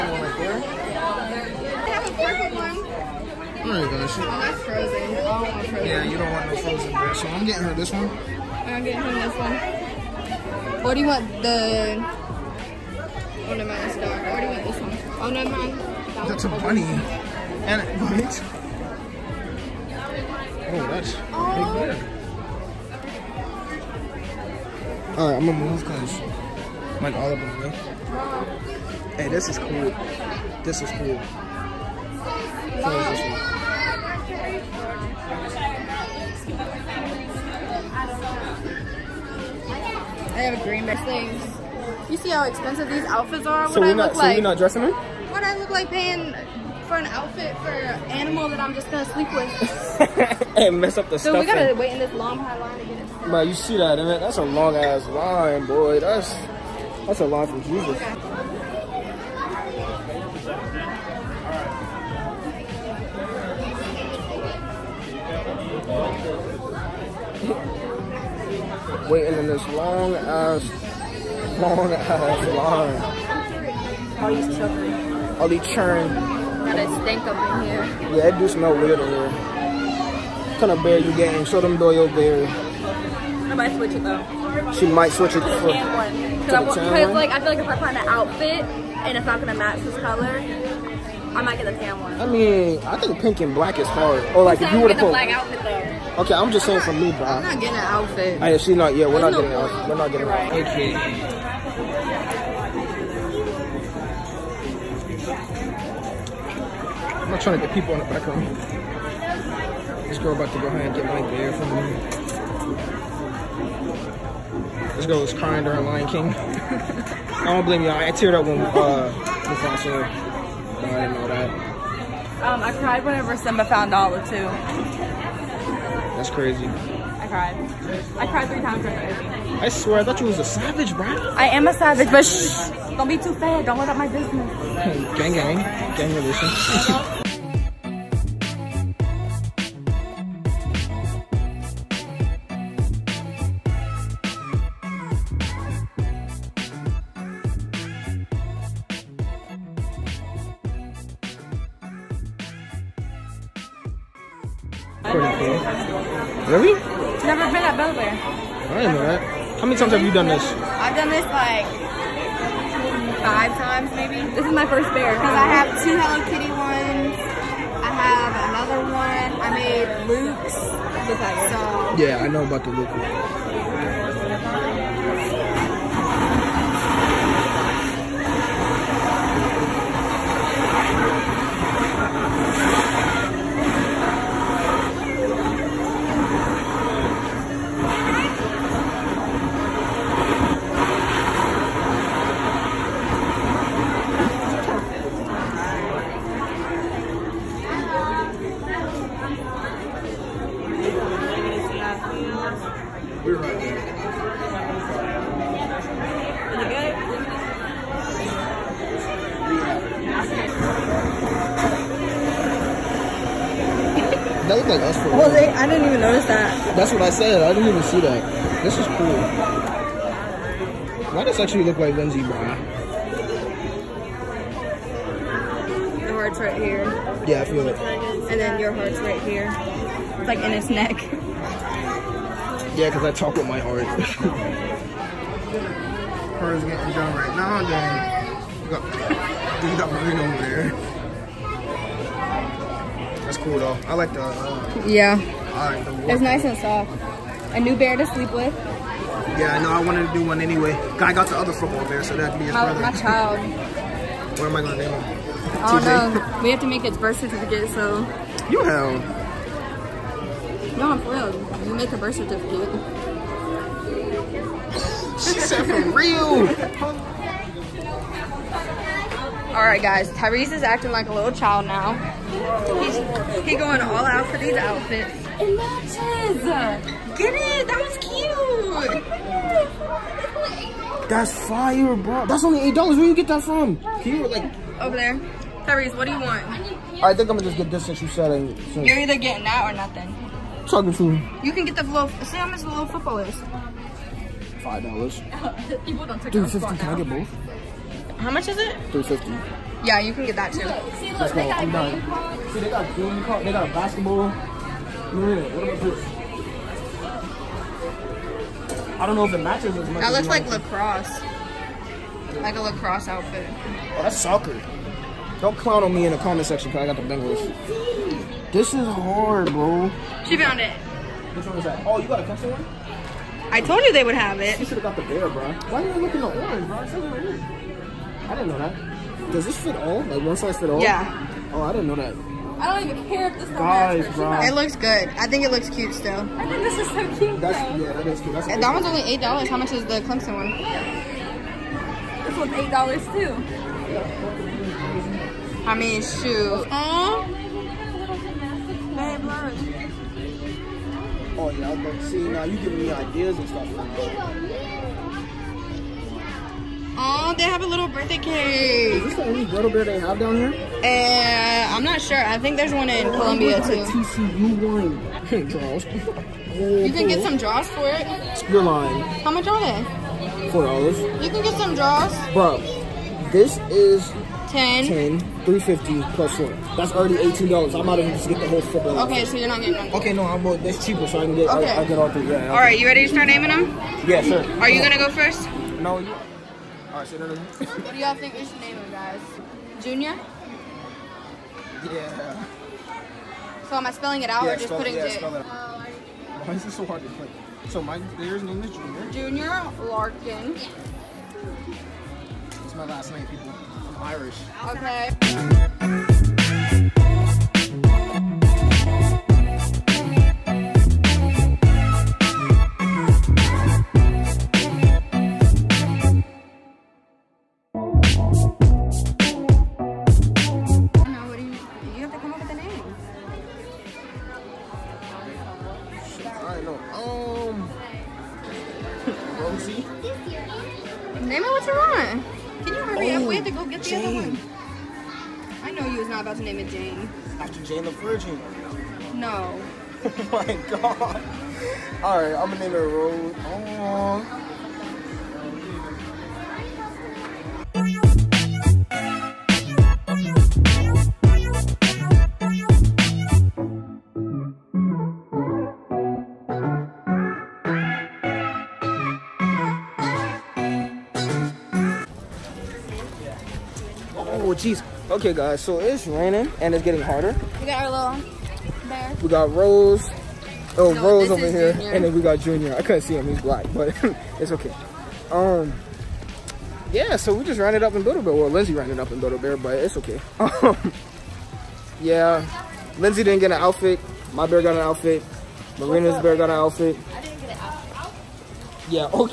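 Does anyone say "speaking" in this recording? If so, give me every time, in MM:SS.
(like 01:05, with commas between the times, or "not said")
not said.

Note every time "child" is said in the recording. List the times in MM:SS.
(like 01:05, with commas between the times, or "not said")
04:12, 04:31.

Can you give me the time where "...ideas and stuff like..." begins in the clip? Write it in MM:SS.
05:52.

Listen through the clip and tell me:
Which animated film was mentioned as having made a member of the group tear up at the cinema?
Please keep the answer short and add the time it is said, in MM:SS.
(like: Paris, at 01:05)
Lion King, at 01:55.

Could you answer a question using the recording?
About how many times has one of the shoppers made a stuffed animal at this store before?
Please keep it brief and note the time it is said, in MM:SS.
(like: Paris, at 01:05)
5, at 02:43.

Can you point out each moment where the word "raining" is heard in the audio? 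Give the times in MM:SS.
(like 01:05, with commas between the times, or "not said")
07:46.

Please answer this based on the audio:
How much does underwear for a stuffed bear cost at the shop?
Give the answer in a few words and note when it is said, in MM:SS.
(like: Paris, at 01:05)
$4, at 06:10.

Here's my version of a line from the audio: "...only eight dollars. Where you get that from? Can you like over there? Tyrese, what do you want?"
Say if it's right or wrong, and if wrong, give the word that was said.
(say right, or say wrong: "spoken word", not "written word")
right.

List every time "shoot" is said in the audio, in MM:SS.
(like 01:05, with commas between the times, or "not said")
00:04, 05:46.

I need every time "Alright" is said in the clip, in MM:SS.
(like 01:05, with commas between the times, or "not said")
00:25, 06:26.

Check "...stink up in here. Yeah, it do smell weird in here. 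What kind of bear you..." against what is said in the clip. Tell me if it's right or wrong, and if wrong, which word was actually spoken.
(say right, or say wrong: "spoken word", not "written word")
right.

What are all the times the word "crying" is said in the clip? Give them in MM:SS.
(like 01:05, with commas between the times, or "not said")
01:55.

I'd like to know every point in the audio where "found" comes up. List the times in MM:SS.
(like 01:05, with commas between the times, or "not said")
02:03, 05:20.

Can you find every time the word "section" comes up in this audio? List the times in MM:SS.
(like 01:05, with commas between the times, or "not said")
05:16.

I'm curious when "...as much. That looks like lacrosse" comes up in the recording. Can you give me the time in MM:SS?
05:09.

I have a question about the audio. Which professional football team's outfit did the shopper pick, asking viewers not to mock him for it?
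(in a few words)
Bengals.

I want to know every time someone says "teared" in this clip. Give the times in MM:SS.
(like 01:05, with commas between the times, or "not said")
01:58.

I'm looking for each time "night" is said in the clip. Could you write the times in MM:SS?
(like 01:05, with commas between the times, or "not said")
not said.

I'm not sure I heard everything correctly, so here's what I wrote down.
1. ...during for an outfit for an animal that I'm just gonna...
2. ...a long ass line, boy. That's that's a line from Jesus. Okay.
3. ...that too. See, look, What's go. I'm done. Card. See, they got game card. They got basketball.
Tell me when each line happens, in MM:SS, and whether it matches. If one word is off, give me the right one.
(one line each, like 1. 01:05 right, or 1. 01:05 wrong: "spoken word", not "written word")
1. 00:45 wrong: "paying", not "during"
2. 00:54 right
3. 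05:00 wrong: "Let", not "What".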